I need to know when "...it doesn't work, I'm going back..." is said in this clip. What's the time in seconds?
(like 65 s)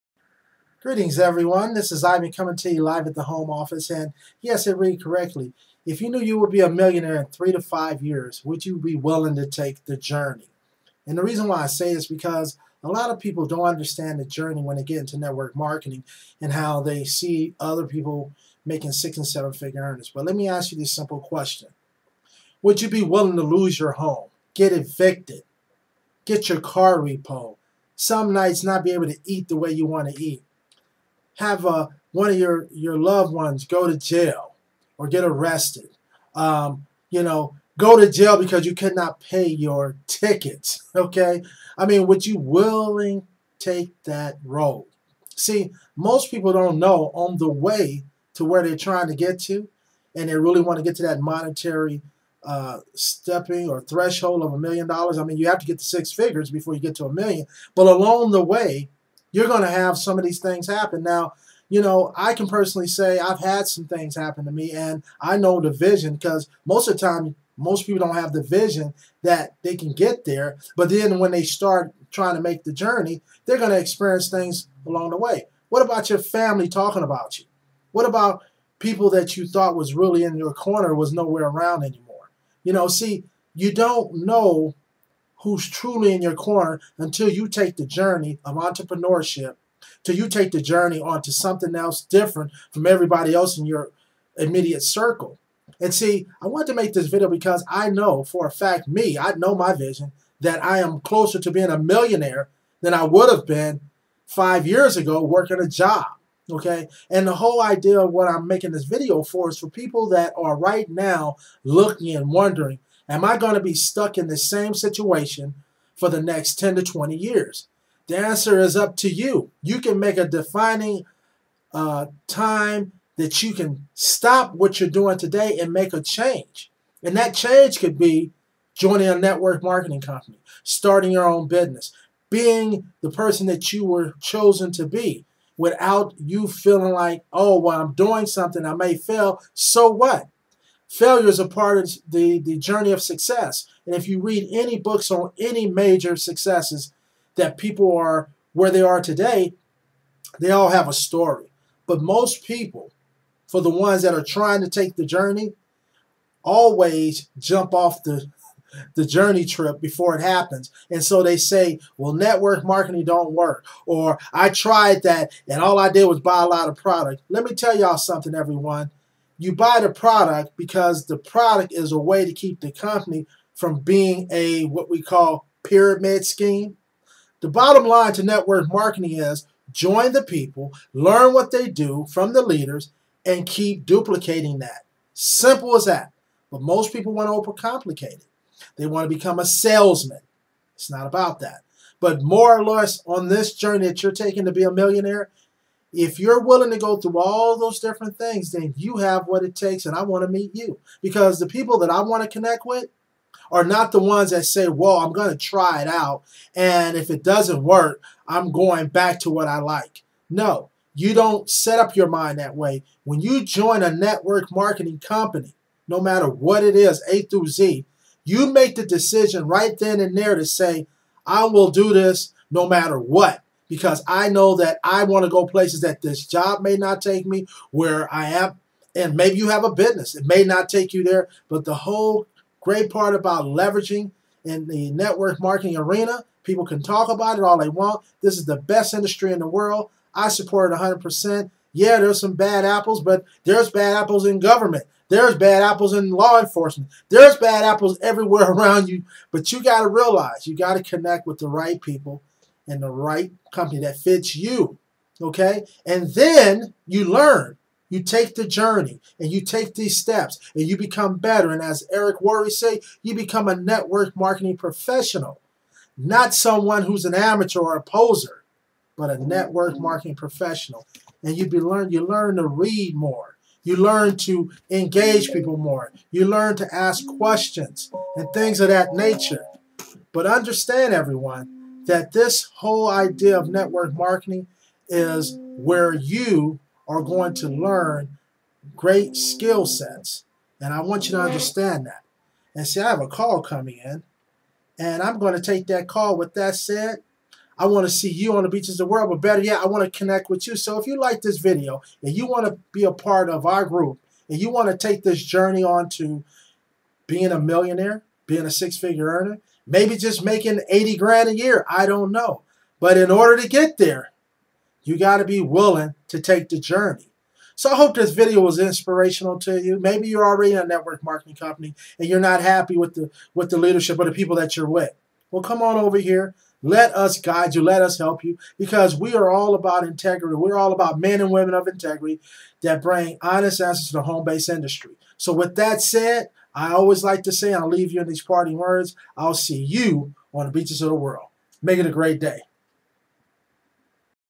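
207 s.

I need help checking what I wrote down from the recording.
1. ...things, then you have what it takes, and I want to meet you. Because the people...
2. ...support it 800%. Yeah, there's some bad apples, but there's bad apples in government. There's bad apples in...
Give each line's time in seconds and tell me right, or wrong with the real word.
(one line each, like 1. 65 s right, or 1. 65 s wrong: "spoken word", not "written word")
1. 198 s right
2. 240 s wrong: "100", not "800".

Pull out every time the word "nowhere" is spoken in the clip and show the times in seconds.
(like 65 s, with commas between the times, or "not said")
81 s.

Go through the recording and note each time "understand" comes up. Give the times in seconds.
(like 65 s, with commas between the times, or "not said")
13 s, 280 s, 291 s.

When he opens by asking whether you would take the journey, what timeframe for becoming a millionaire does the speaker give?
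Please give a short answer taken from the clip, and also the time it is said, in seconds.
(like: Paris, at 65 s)
3 to 5 years, at 7 s.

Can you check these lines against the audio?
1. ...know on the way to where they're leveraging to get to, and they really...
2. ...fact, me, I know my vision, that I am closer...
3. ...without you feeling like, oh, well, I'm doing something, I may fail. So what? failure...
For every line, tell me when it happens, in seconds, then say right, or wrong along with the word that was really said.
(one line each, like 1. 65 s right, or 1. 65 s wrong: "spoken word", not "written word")
1. 46 s wrong: "trying", not "leveraging"
2. 98 s right
3. 135 s right.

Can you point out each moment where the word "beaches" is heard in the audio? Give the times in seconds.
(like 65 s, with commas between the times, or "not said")
298 s, 340 s.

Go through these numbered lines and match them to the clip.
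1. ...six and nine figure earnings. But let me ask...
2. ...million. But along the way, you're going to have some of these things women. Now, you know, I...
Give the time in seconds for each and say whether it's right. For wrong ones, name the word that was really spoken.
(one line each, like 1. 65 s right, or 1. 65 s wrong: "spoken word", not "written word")
1. 18 s wrong: "seven", not "nine"
2. 57 s wrong: "happen", not "women".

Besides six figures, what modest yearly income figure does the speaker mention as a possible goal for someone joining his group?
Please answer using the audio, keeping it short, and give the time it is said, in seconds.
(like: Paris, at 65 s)
80 grand, at 310 s.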